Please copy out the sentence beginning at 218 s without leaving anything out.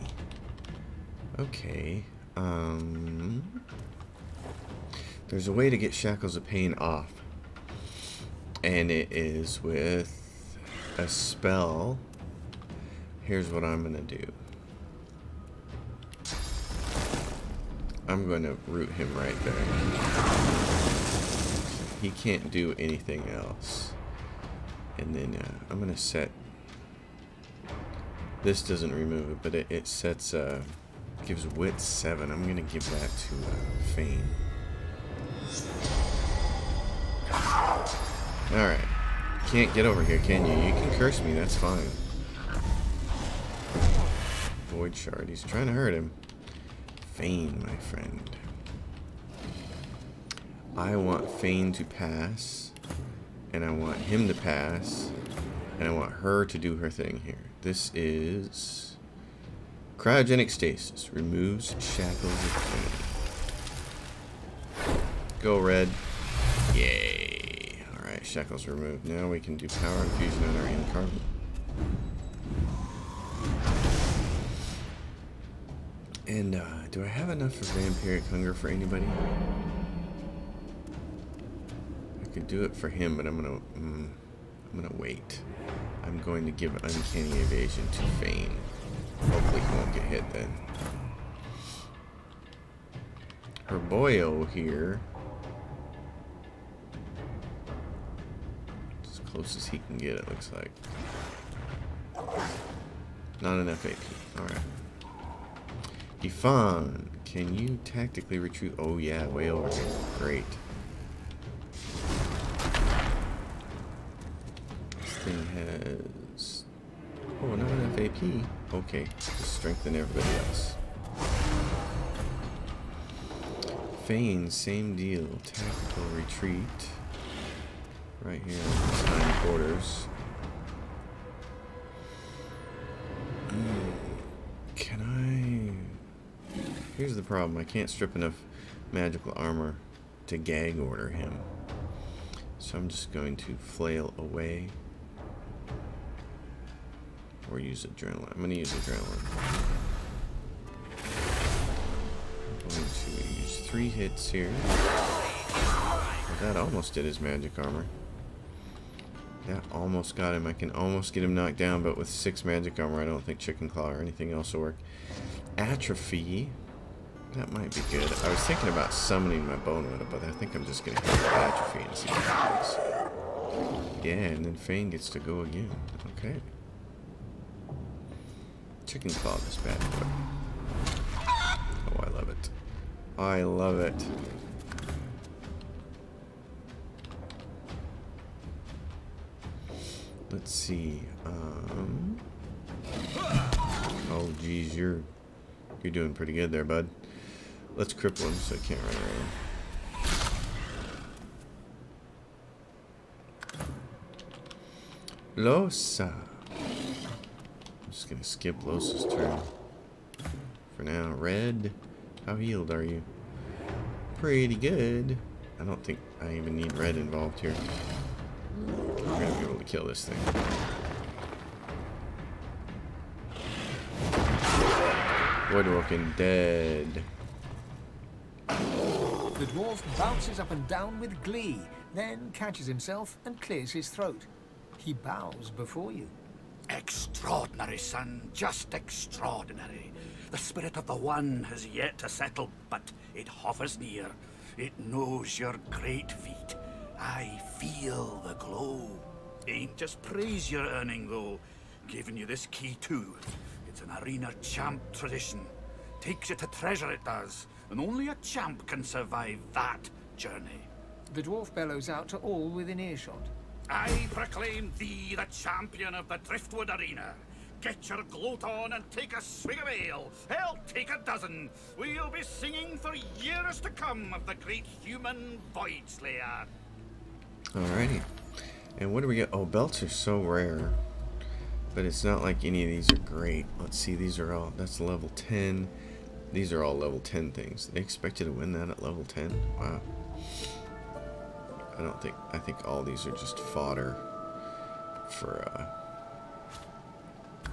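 We're gonna be able to kill this thing.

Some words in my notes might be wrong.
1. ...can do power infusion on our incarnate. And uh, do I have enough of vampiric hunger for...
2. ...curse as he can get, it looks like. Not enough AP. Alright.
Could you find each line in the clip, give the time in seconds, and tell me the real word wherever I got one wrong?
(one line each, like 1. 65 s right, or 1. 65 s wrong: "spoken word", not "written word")
1. 69 s right
2. 99 s wrong: "close", not "curse".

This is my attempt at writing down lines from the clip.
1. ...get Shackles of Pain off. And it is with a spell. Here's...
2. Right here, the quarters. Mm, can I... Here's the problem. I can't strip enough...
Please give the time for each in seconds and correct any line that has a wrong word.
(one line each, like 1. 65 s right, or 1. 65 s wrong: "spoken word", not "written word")
1. 5 s right
2. 128 s right.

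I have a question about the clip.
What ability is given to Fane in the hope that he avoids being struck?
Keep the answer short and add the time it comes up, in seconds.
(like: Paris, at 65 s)
Uncanny Evasion, at 86 s.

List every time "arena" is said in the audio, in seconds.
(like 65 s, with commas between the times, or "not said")
254 s, 266 s.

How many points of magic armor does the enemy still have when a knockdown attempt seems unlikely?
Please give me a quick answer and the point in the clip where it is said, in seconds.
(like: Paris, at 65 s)
6, at 162 s.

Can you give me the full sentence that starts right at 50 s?
I want Fane to pass, and I want him to pass, and I want her to do her thing here.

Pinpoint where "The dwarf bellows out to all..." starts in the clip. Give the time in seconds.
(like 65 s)
261 s.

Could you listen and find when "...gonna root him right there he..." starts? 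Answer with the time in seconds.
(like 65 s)
18 s.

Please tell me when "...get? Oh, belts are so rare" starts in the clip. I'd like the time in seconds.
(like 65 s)
279 s.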